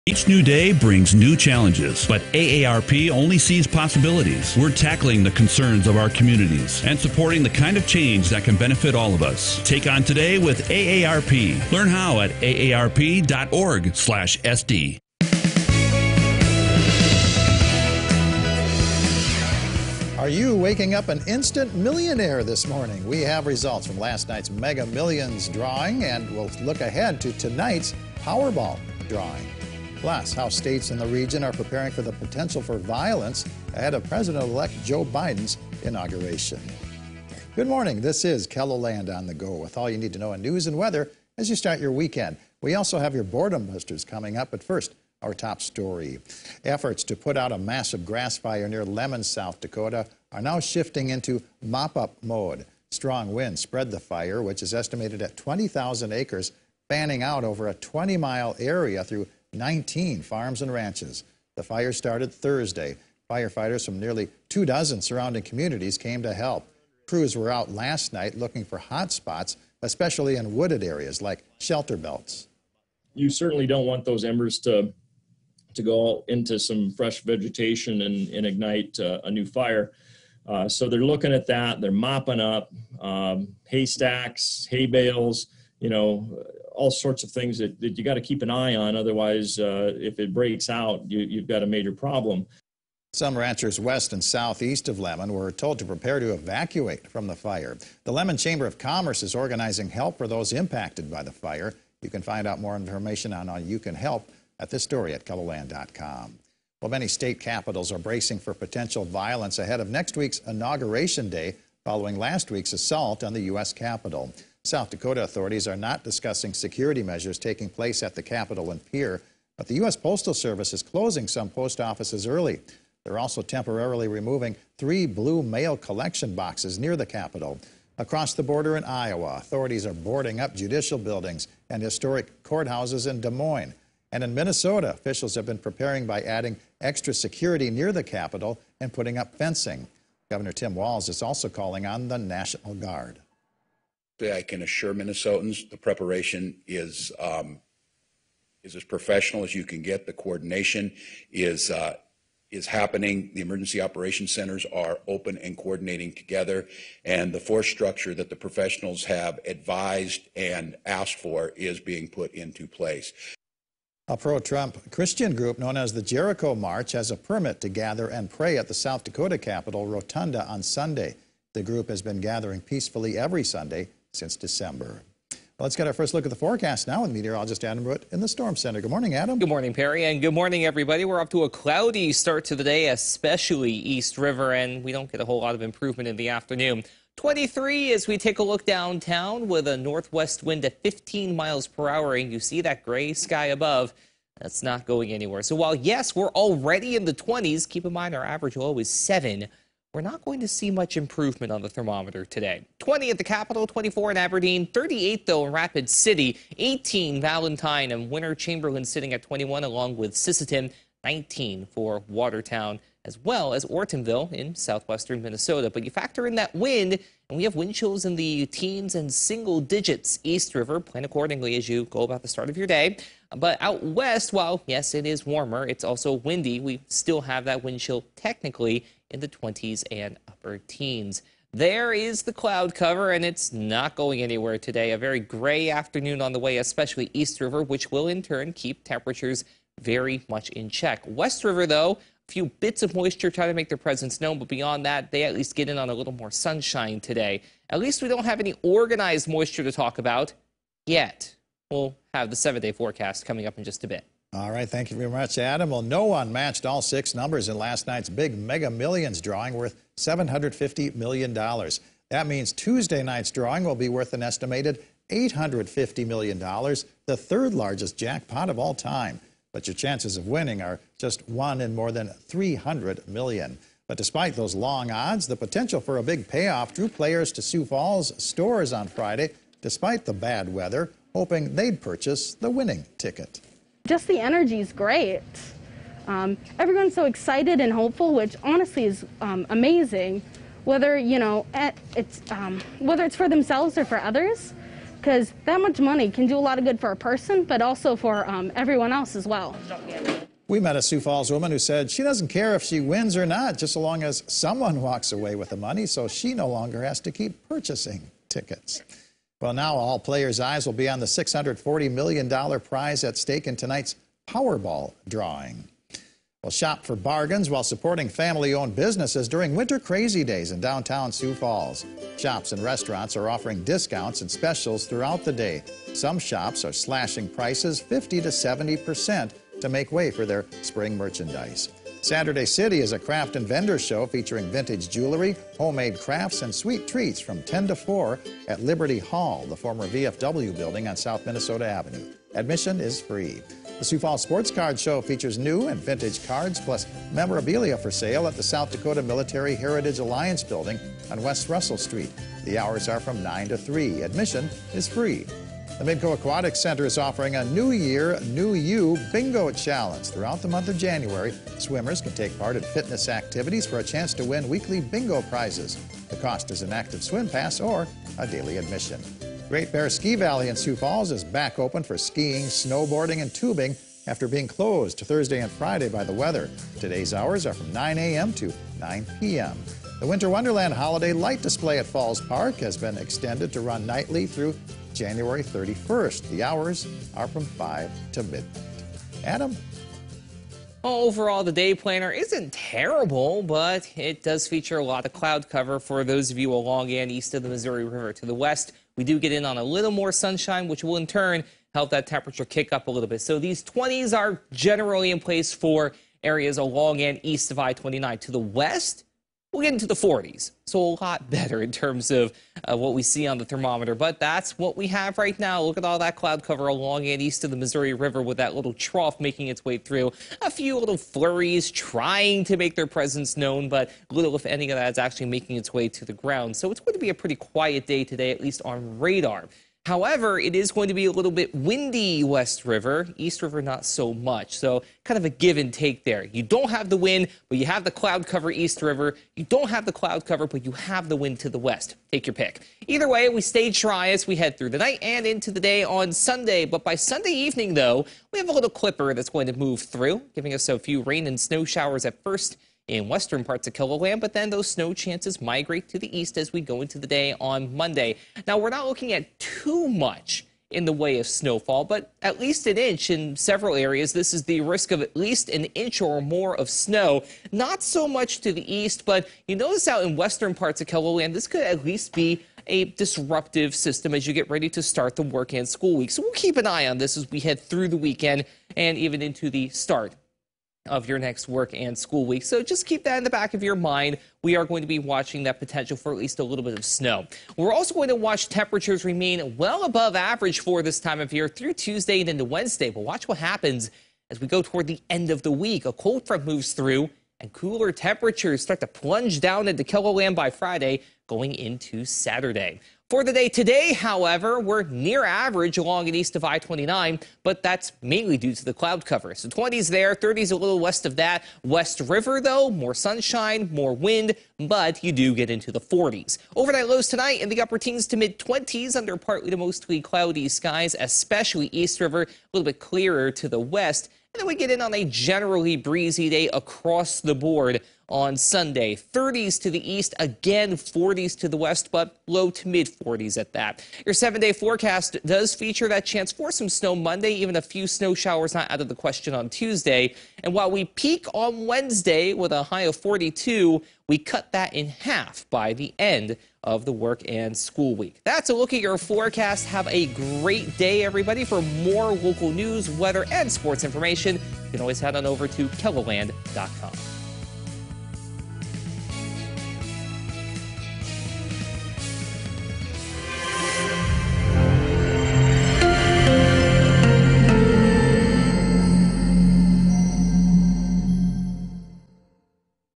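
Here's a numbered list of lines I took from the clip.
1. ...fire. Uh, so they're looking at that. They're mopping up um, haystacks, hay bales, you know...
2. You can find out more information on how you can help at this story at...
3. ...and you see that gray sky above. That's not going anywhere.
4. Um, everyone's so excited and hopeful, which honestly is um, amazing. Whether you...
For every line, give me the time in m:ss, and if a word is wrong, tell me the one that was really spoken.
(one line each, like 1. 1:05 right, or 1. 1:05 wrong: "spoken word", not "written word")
1. 1:19 right
2. 1:42 right
3. 3:12 right
4. 4:46 right.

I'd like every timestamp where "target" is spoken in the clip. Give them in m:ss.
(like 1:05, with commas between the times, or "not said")
not said.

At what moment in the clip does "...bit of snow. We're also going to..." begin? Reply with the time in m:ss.
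8:06.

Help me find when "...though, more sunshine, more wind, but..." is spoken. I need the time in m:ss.
8:32.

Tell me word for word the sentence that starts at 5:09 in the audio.
Well, now all players' eyes will be on the $640 million prize at stake in tonight's Powerball drawing.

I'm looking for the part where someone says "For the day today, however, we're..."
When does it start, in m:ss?
8:23.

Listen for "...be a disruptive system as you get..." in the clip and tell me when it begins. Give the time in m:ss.
7:52.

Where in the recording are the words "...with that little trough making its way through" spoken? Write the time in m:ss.
6:58.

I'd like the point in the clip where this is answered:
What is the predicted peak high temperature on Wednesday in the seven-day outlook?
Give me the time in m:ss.
9:02.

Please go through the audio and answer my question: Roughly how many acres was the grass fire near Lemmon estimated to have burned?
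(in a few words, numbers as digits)
20,000.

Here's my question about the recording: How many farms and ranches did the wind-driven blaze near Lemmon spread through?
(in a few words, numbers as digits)
19.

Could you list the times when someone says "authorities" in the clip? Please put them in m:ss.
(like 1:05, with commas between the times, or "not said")
1:55, 2:09.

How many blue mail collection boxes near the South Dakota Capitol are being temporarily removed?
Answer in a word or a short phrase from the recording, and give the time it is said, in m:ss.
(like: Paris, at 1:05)
3, at 2:04.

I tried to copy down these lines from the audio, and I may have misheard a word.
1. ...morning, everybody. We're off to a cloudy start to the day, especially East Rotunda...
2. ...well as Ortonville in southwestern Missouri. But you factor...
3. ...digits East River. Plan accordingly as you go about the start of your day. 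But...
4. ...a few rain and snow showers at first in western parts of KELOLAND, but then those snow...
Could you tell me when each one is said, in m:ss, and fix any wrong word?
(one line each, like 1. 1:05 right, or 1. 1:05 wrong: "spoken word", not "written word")
1. 3:00 wrong: "River", not "Rotunda"
2. 3:33 wrong: "Minnesota", not "Missouri"
3. 3:39 right
4. 7:30 right.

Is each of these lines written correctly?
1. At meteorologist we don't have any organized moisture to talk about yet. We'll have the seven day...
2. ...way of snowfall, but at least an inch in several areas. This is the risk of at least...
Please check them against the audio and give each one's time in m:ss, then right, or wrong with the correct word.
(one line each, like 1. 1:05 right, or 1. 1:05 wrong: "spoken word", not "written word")
1. 4:07 wrong: "least", not "meteorologist"
2. 7:40 right.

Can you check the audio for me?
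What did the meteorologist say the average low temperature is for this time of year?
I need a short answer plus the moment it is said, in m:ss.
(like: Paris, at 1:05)
7, at 3:18.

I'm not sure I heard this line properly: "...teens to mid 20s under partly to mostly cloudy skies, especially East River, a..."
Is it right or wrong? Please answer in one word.
right.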